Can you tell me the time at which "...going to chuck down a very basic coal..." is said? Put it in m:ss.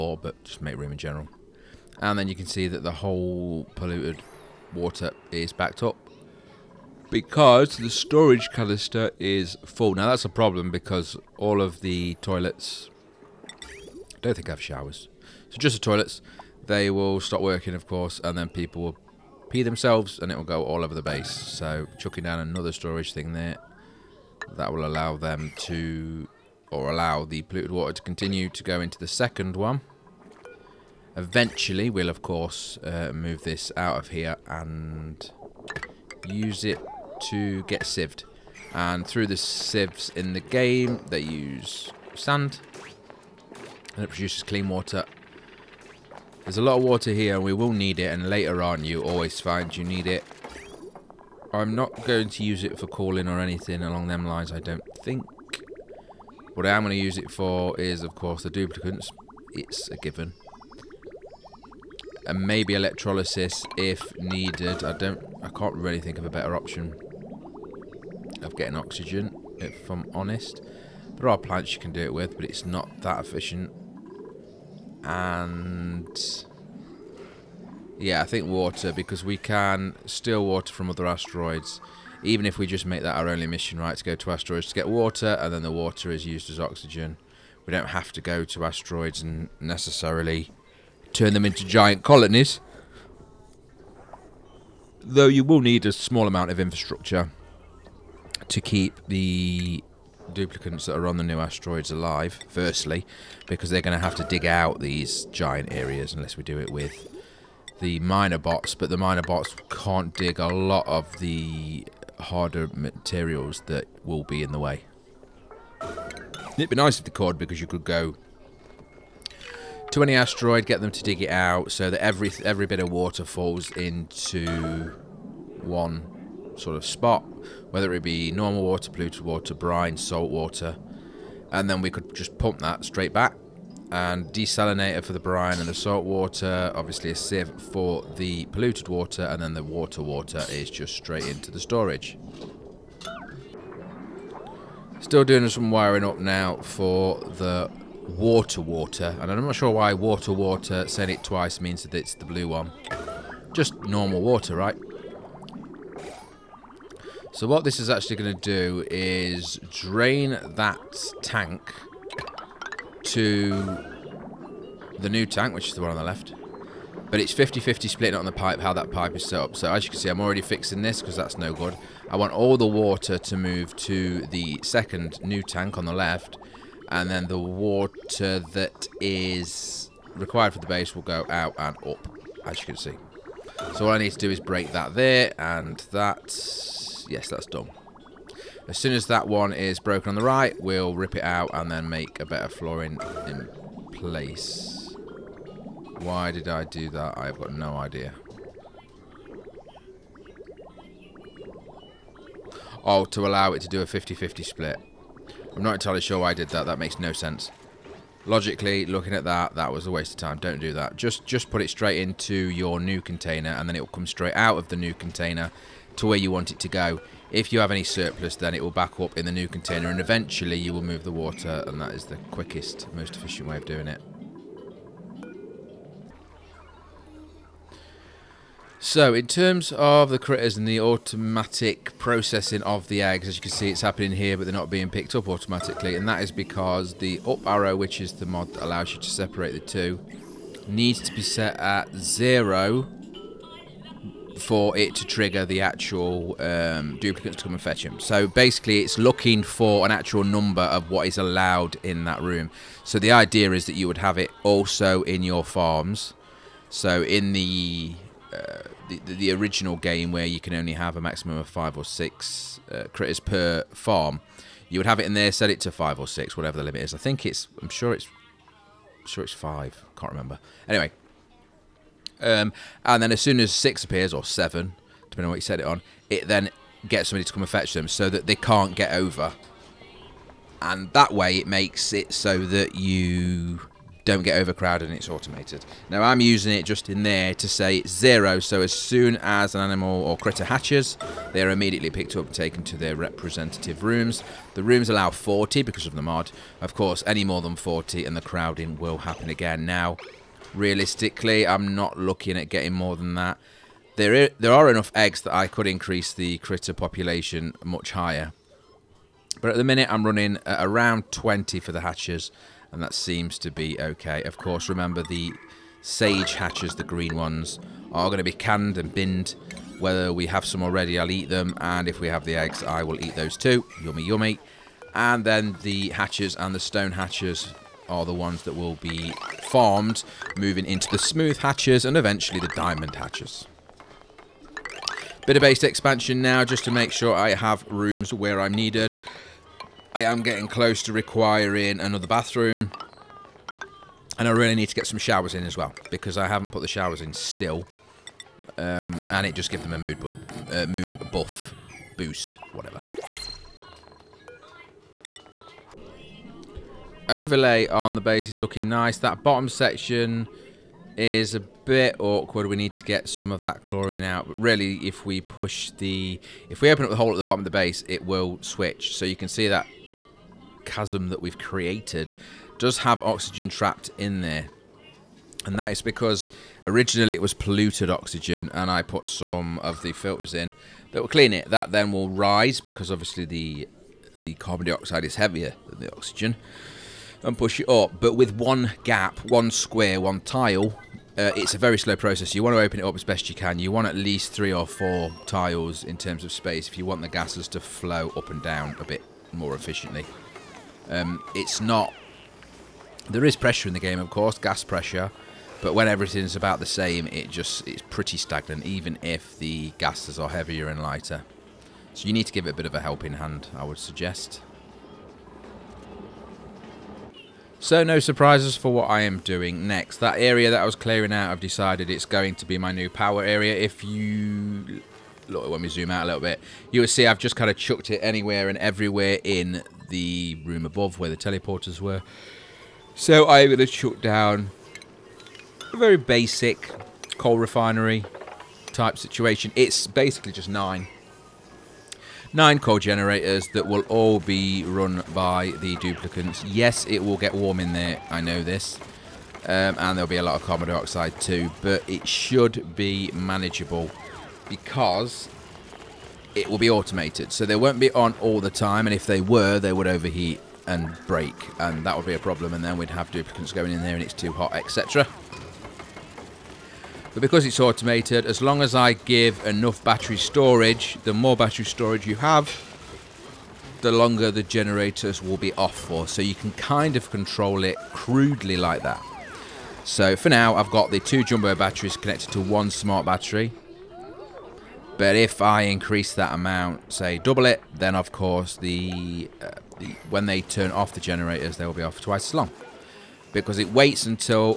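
7:13.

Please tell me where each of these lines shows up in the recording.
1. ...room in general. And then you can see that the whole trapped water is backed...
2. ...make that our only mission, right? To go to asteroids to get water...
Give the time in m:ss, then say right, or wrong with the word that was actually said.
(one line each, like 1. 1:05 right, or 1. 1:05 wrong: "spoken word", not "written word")
1. 0:00 wrong: "polluted", not "trapped"
2. 1:22 right.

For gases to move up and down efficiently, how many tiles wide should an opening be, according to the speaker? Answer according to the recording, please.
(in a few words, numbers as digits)
3 or 4.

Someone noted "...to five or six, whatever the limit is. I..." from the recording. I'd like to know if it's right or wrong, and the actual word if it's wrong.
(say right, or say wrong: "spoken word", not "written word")
right.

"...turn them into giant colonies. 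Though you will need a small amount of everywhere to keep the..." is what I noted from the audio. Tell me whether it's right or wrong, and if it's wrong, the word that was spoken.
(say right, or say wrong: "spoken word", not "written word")
wrong: "infrastructure", not "everywhere".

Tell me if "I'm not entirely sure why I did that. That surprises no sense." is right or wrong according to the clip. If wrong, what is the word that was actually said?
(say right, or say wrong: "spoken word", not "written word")
wrong: "makes", not "surprises".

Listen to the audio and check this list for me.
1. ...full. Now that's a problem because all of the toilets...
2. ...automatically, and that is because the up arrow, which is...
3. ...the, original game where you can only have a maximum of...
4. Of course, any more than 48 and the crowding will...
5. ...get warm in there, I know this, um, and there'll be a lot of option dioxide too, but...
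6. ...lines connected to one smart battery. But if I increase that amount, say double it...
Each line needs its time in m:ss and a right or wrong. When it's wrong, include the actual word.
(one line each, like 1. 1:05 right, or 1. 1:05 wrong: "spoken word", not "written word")
1. 0:09 right
2. 3:55 right
3. 4:19 right
4. 4:56 wrong: "40", not "48"
5. 7:27 wrong: "carbon", not "option"
6. 8:01 wrong: "batteries", not "lines".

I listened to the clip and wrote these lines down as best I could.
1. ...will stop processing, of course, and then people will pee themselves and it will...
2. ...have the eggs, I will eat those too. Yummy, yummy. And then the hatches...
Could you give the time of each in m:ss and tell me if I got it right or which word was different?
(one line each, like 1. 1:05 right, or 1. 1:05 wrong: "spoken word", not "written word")
1. 0:16 wrong: "working", not "processing"
2. 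5:22 right.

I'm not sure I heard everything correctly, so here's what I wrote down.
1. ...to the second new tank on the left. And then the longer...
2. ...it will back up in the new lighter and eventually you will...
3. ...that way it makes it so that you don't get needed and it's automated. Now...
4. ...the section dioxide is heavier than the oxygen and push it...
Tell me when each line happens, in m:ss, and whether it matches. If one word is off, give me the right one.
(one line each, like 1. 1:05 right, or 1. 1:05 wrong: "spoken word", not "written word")
1. 2:53 wrong: "water", not "longer"
2. 3:38 wrong: "container", not "lighter"
3. 4:40 wrong: "overcrowded", not "needed"
4. 6:24 wrong: "carbon", not "section".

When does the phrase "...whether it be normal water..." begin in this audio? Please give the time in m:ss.
2:07.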